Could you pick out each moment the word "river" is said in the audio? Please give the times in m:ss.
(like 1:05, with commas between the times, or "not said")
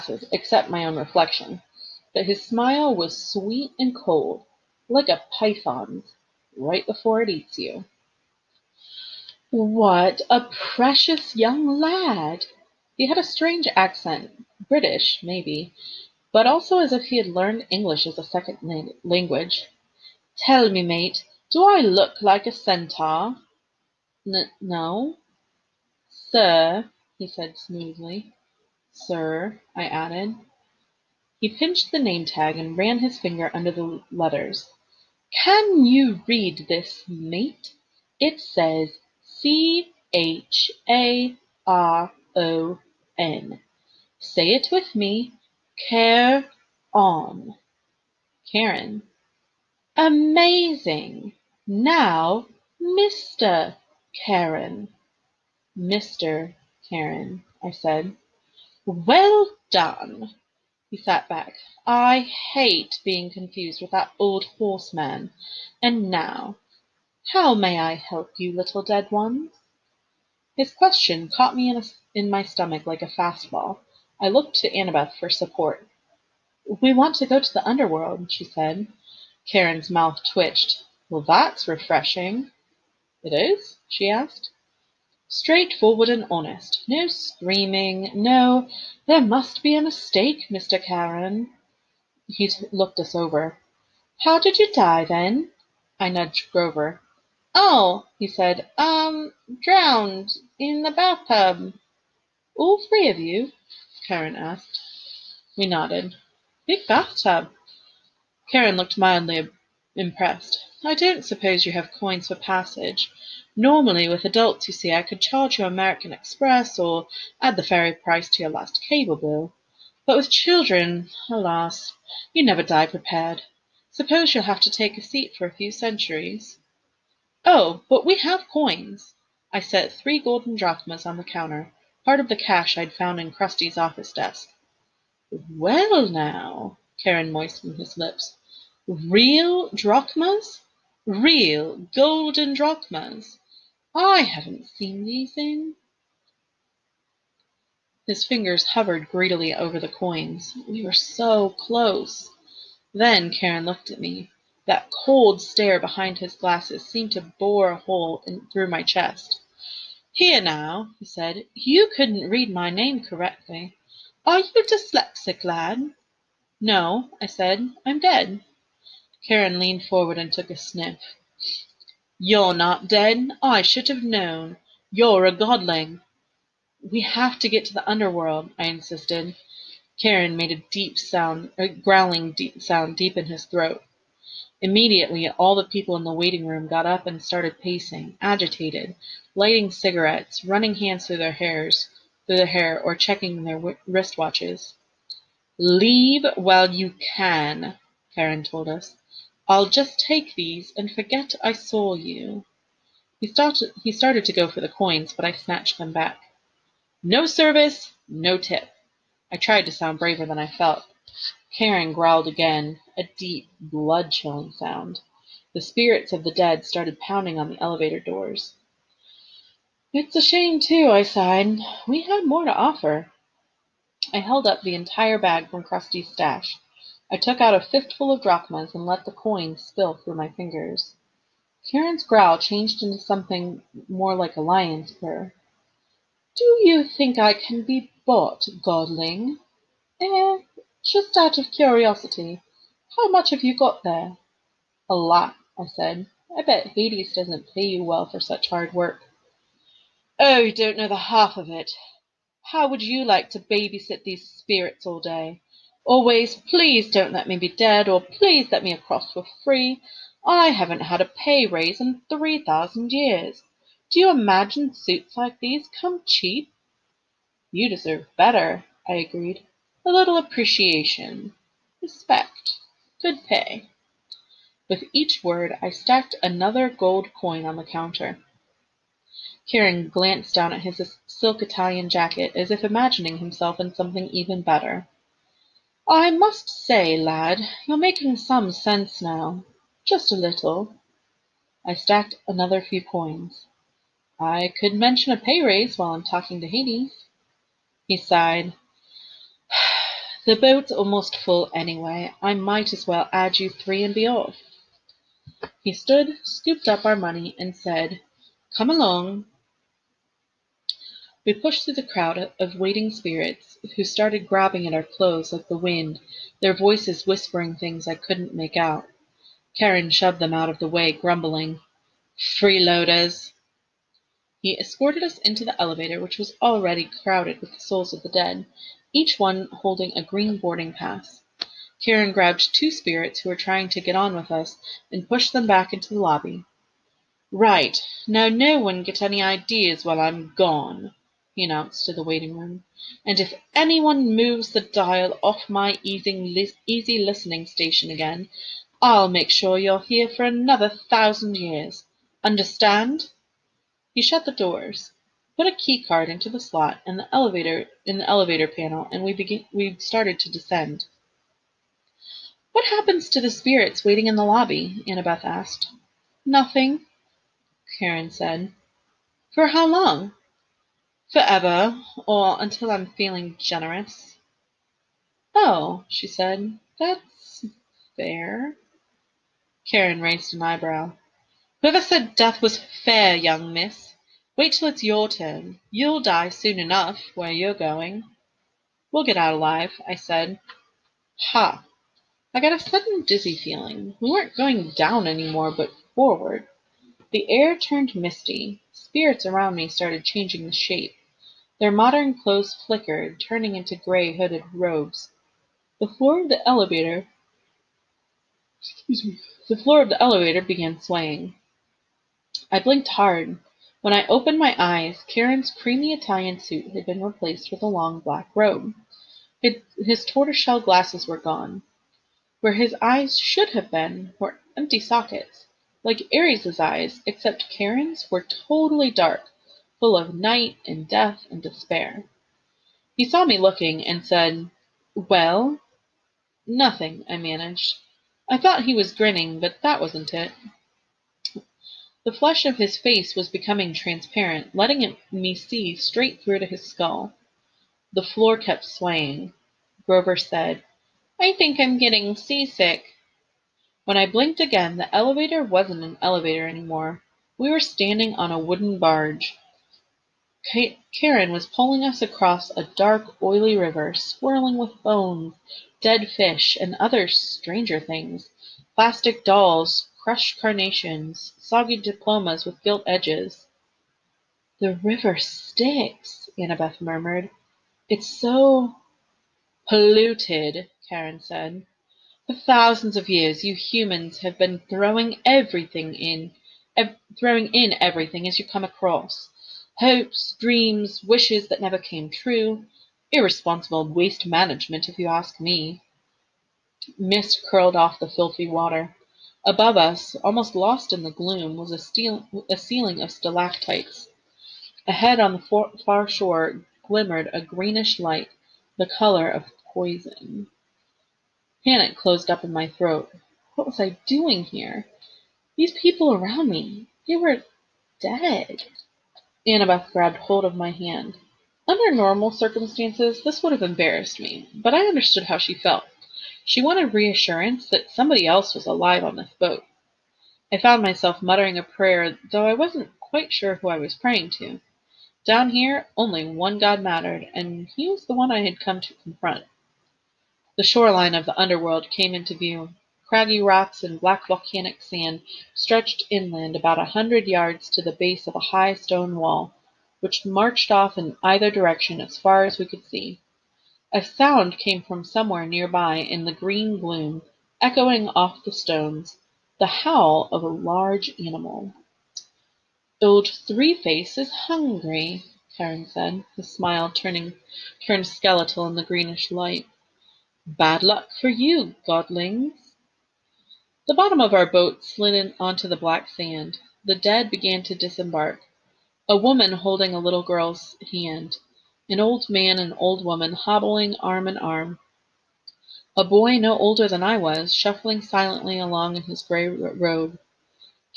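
7:43, 7:54.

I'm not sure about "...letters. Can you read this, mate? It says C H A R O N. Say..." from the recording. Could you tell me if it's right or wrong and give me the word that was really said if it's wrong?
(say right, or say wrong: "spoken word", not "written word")
right.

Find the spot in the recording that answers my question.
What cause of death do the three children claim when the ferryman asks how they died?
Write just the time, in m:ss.
1:39.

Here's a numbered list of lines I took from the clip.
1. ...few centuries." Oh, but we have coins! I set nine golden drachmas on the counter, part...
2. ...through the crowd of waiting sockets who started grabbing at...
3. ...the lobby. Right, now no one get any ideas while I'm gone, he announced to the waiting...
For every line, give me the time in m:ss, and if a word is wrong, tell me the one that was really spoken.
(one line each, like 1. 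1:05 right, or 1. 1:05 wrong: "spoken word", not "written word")
1. 2:05 wrong: "three", not "nine"
2. 5:11 wrong: "spirits", not "sockets"
3. 5:35 right.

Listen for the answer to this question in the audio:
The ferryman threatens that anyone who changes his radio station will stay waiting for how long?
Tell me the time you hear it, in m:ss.
5:50.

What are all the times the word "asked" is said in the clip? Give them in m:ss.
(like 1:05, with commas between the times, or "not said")
1:24, 1:44, 6:05.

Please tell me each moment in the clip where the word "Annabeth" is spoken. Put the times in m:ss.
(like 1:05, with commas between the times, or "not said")
1:14, 6:04, 7:56, 8:39.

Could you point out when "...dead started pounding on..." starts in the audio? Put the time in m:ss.
3:36.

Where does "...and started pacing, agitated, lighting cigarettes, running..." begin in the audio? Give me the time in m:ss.
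3:07.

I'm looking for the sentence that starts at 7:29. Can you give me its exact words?
Grover said, I think I'm getting seasick.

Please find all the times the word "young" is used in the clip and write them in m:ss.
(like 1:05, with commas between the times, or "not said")
0:11, 6:23.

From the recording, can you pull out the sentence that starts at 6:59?
His, his tortoiseshell glasses were gone.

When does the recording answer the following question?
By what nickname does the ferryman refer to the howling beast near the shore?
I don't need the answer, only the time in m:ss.
9:22.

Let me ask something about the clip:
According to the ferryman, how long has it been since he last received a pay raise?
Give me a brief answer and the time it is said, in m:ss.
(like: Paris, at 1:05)
3000 years, at 4:22.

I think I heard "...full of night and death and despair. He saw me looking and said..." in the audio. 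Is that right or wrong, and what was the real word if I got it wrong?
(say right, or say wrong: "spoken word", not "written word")
right.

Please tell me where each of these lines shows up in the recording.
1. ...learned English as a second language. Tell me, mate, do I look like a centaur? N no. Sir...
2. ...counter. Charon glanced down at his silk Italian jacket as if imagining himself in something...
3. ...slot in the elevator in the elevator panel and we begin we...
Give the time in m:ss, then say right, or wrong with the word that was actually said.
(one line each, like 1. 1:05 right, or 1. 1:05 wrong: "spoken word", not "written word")
1. 0:17 right
2. 4:37 right
3. 5:56 right.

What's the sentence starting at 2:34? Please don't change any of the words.
That cold stare behind his glasses seemed to bore a hole in, through my chest.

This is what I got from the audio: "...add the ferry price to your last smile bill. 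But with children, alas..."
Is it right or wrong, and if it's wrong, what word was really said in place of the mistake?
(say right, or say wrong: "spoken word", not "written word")
wrong: "cable", not "smile".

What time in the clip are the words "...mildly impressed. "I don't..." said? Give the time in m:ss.
1:48.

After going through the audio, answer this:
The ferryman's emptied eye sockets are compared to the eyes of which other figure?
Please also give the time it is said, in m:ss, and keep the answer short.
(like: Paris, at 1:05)
Ares, at 7:06.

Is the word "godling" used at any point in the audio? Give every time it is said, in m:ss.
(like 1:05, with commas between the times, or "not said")
2:55, 3:58, 9:31.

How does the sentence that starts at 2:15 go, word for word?
Well, now, Charon moistened his lips.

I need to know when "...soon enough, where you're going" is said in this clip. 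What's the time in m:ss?
6:26.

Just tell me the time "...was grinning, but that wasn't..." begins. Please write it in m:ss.
7:18.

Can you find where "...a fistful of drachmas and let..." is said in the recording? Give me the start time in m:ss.
3:47.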